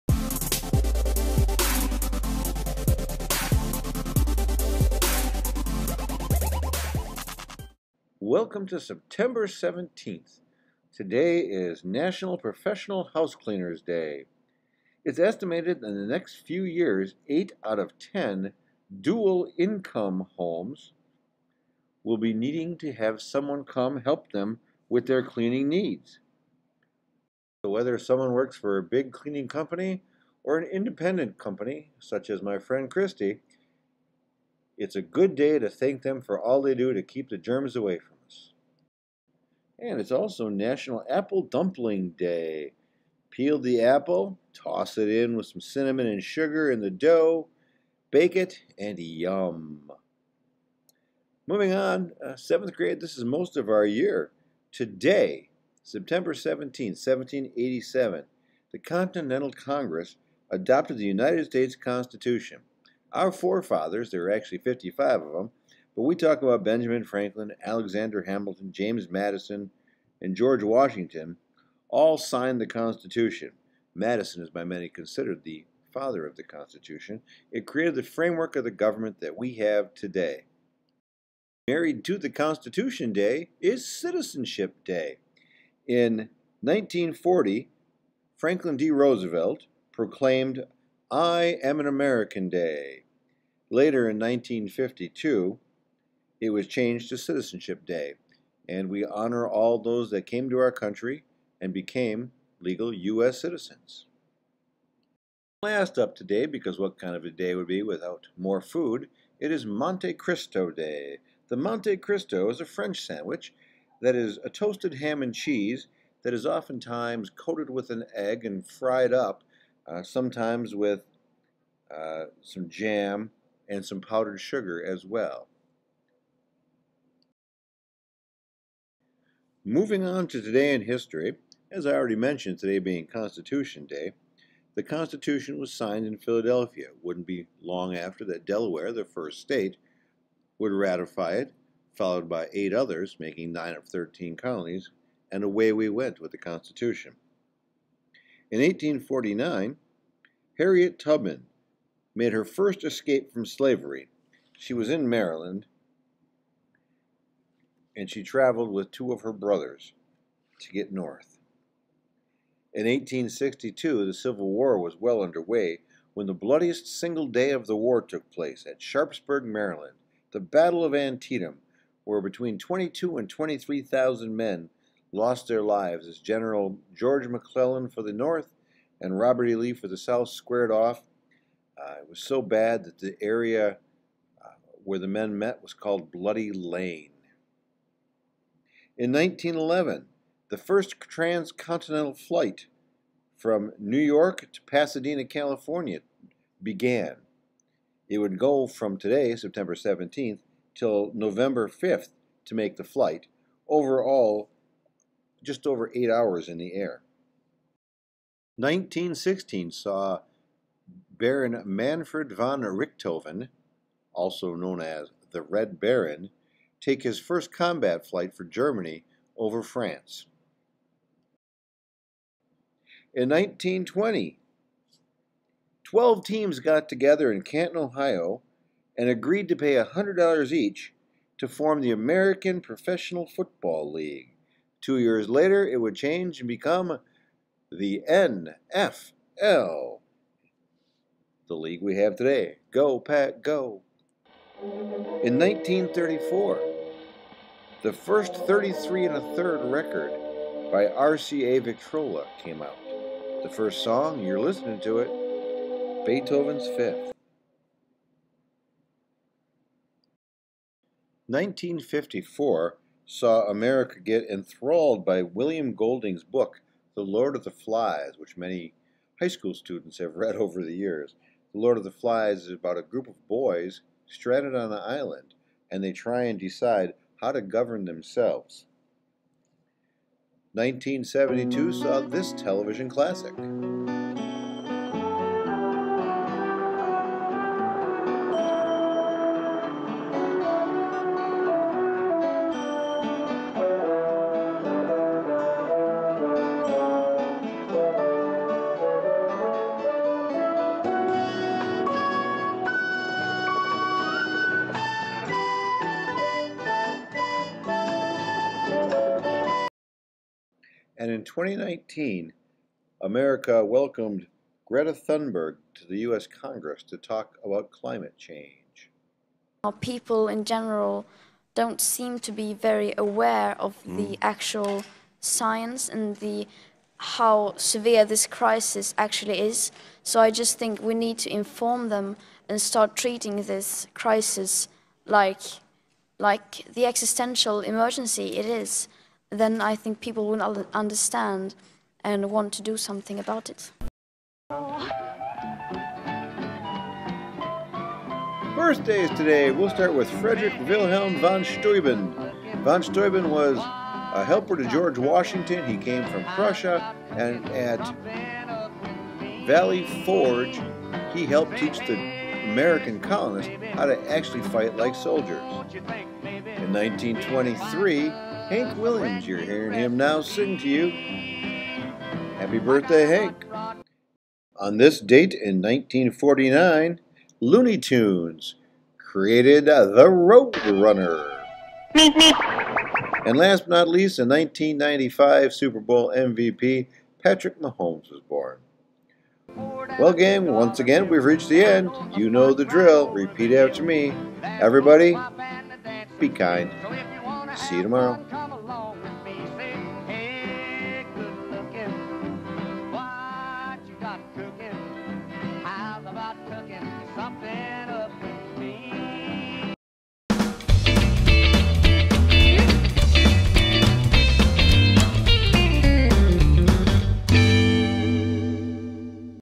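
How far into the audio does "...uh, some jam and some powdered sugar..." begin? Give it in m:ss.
2:01.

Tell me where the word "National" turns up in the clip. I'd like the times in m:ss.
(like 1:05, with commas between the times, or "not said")
0:11, 0:40.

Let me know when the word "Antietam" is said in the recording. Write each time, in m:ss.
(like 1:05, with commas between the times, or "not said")
2:50.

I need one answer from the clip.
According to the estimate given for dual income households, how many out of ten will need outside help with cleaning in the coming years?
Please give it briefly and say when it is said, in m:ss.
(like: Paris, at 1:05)
8, at 0:17.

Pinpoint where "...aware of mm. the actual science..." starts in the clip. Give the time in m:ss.
5:22.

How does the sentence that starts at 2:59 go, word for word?
Lee for the South squared off.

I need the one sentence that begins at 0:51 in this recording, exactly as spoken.
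Moving on, uh, seventh grade, this is most of our year.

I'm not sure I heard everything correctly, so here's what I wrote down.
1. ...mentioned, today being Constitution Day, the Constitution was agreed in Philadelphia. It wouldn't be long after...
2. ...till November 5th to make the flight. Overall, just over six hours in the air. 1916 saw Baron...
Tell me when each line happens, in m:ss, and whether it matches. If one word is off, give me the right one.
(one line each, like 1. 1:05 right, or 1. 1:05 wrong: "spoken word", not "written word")
1. 2:12 wrong: "signed", not "agreed"
2. 3:20 wrong: "eight", not "six".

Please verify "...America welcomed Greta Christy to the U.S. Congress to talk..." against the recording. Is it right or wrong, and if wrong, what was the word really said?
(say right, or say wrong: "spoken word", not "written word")
wrong: "Thunberg", not "Christy".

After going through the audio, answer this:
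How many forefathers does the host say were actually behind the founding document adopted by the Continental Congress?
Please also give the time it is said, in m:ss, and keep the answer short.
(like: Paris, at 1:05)
55, at 1:04.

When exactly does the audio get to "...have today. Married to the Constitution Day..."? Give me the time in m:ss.
1:19.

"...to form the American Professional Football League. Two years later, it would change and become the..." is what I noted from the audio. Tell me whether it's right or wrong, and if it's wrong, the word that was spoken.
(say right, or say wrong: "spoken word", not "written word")
right.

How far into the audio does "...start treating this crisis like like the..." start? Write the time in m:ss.
5:32.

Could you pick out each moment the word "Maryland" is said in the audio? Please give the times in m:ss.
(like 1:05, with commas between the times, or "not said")
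2:35, 2:49.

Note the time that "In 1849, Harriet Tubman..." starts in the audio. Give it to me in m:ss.
2:28.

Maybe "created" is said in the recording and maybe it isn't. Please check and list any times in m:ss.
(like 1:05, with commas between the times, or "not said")
1:17, 6:18.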